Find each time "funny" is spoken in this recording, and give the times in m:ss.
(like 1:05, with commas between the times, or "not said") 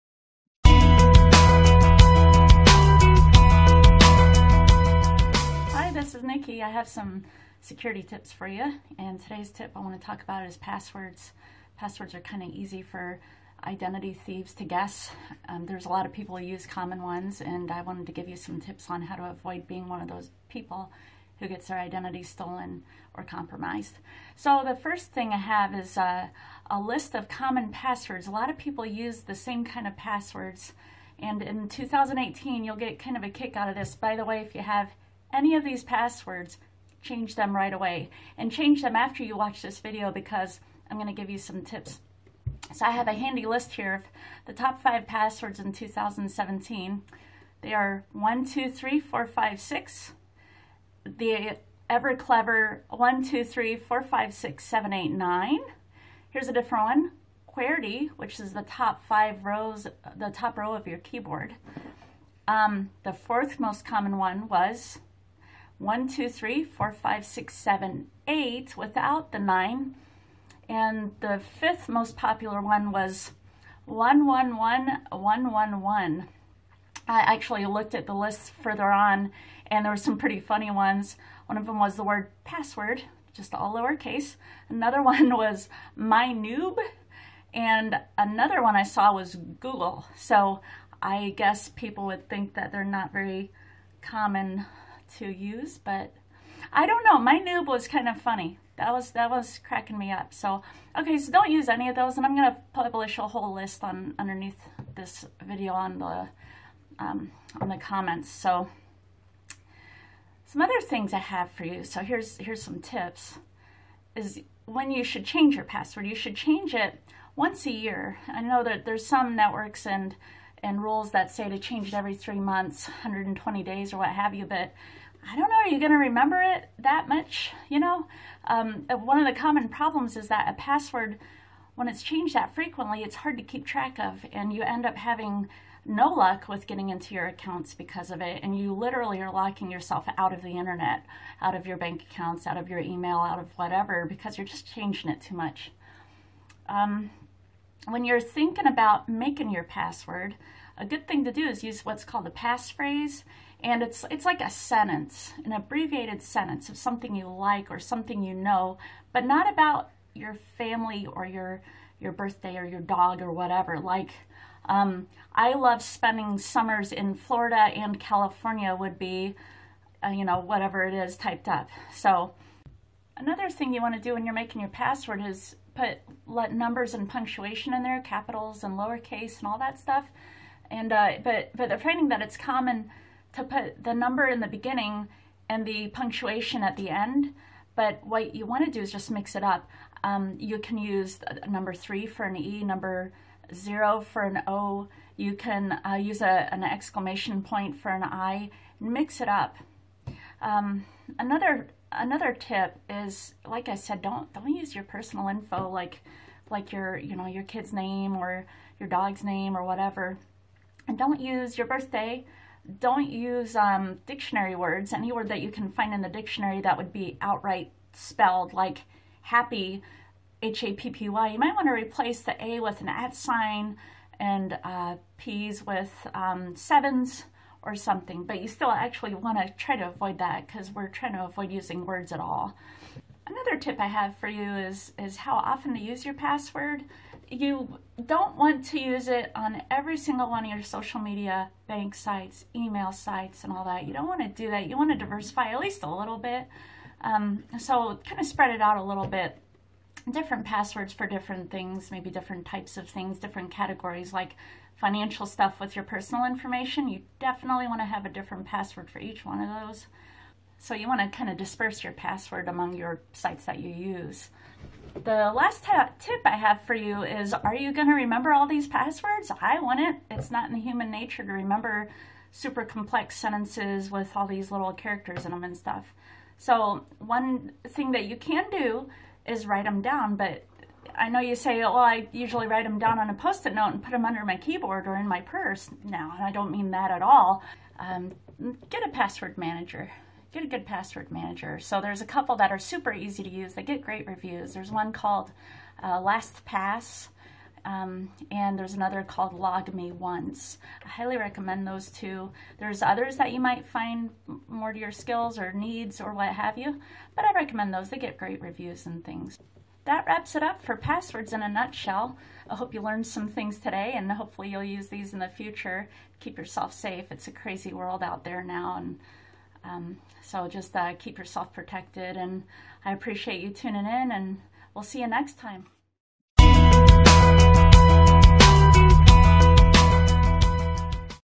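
1:20, 1:38.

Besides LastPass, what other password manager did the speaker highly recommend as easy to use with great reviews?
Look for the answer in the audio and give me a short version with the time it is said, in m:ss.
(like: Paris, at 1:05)
LogMeOnce, at 4:59.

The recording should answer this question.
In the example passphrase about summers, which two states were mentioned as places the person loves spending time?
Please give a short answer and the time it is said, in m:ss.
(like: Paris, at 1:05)
Florida and California, at 2:47.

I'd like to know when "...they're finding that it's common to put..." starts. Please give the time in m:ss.
3:01.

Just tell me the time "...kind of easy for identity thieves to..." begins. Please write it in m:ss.
0:12.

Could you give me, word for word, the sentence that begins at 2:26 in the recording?
Um, when you're thinking about making your password, a good thing to do is use what's called a passphrase.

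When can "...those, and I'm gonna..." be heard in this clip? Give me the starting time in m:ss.
1:41.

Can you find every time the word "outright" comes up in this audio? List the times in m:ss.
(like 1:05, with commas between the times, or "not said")
3:37.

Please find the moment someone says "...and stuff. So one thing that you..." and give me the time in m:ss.
4:35.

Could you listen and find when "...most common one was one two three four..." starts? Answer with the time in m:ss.
1:03.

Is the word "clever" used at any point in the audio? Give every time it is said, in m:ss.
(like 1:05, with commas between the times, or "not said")
0:52.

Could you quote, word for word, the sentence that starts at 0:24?
So the first thing I have is uh, a list of common passwords.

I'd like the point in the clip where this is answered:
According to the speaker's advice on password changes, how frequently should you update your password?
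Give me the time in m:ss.
1:57.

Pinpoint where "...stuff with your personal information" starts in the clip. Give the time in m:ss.
4:15.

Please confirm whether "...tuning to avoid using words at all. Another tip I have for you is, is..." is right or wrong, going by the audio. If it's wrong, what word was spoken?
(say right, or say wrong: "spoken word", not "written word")
wrong: "trying", not "tuning".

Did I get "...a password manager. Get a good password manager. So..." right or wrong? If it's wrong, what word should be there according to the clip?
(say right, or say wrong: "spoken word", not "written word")
right.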